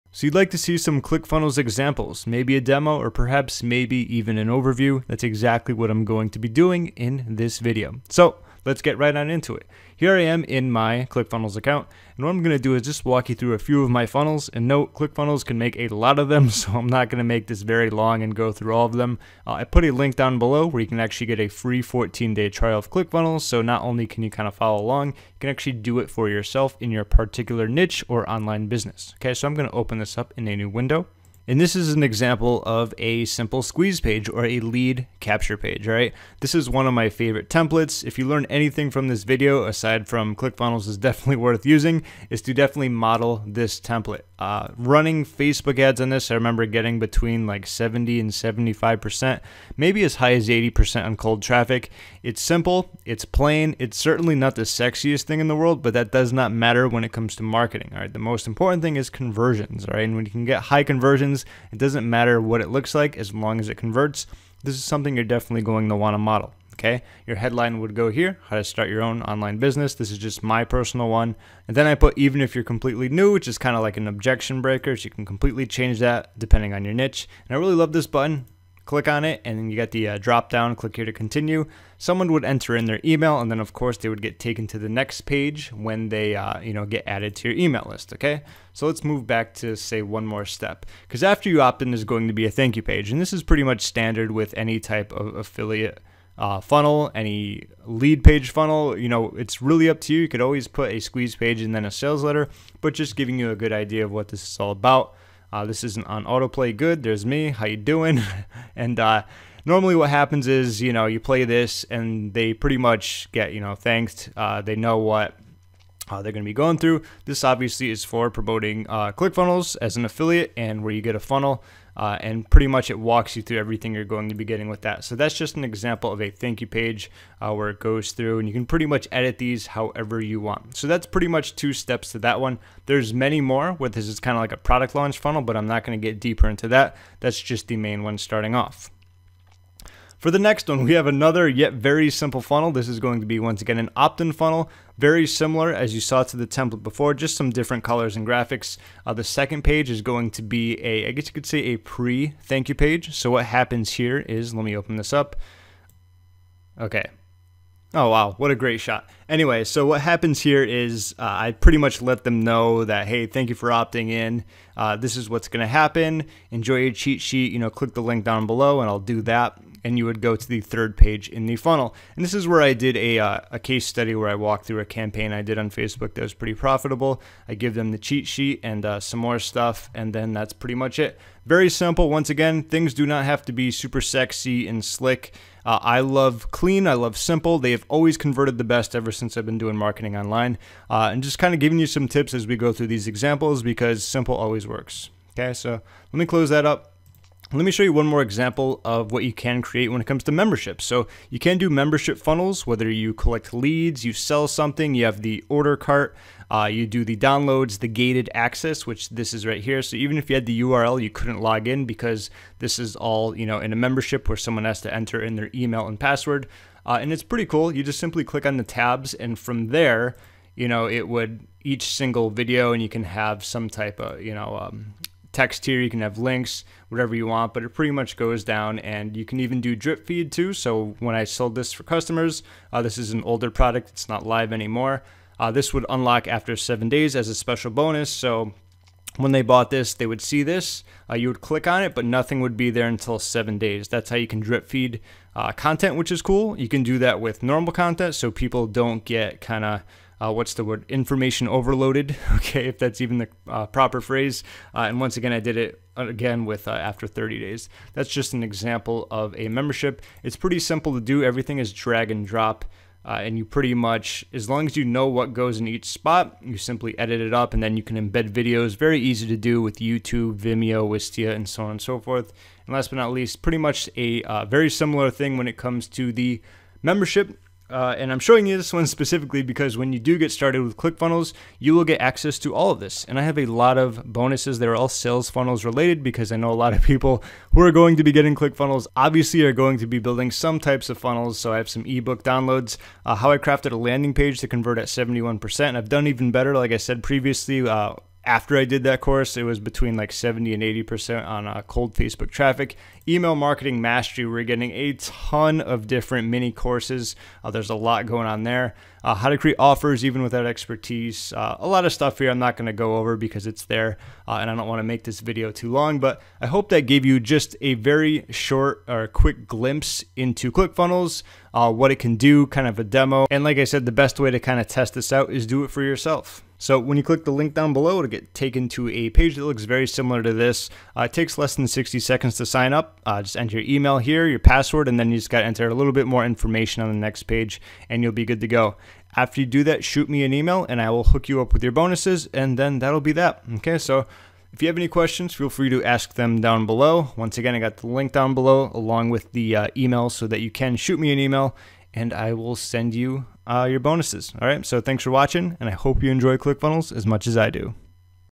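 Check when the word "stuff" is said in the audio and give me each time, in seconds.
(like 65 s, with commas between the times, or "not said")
179 s, 311 s.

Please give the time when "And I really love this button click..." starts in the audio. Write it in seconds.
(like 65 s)
77 s.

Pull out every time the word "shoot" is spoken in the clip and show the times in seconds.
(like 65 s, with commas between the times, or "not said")
339 s, 350 s.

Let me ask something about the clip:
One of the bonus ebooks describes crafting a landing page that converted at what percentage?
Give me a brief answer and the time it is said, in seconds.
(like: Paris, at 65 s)
71%, at 294 s.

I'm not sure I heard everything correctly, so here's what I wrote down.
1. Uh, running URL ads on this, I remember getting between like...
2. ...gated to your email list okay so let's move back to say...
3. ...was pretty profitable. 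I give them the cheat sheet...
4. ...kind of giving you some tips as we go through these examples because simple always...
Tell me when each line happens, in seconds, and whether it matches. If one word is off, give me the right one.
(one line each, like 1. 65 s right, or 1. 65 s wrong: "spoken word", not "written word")
1. 44 s wrong: "Facebook", not "URL"
2. 87 s wrong: "added", not "gated"
3. 176 s right
4. 191 s right.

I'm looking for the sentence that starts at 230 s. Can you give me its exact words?
So when I sold this for customers, uh, this is an older product, it's not live anymore.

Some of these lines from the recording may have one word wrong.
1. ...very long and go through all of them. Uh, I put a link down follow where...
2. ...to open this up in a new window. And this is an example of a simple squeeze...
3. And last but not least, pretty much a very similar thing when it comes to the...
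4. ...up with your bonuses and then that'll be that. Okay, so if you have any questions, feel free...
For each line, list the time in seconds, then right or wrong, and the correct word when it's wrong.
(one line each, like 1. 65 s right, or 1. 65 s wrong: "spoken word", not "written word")
1. 17 s wrong: "below", not "follow"
2. 29 s right
3. 272 s right
4. 341 s right.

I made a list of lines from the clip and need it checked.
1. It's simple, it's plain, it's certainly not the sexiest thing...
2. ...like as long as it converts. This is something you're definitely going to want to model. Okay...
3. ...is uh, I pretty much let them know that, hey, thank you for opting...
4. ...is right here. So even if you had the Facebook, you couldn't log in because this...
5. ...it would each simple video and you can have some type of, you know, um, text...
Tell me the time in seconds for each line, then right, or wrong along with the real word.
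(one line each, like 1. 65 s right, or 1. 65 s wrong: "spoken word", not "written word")
1. 52 s right
2. 62 s right
3. 160 s right
4. 209 s wrong: "URL", not "Facebook"
5. 220 s wrong: "single", not "simple".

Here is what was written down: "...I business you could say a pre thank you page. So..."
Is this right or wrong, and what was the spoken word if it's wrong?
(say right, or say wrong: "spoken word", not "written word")
wrong: "guess", not "business".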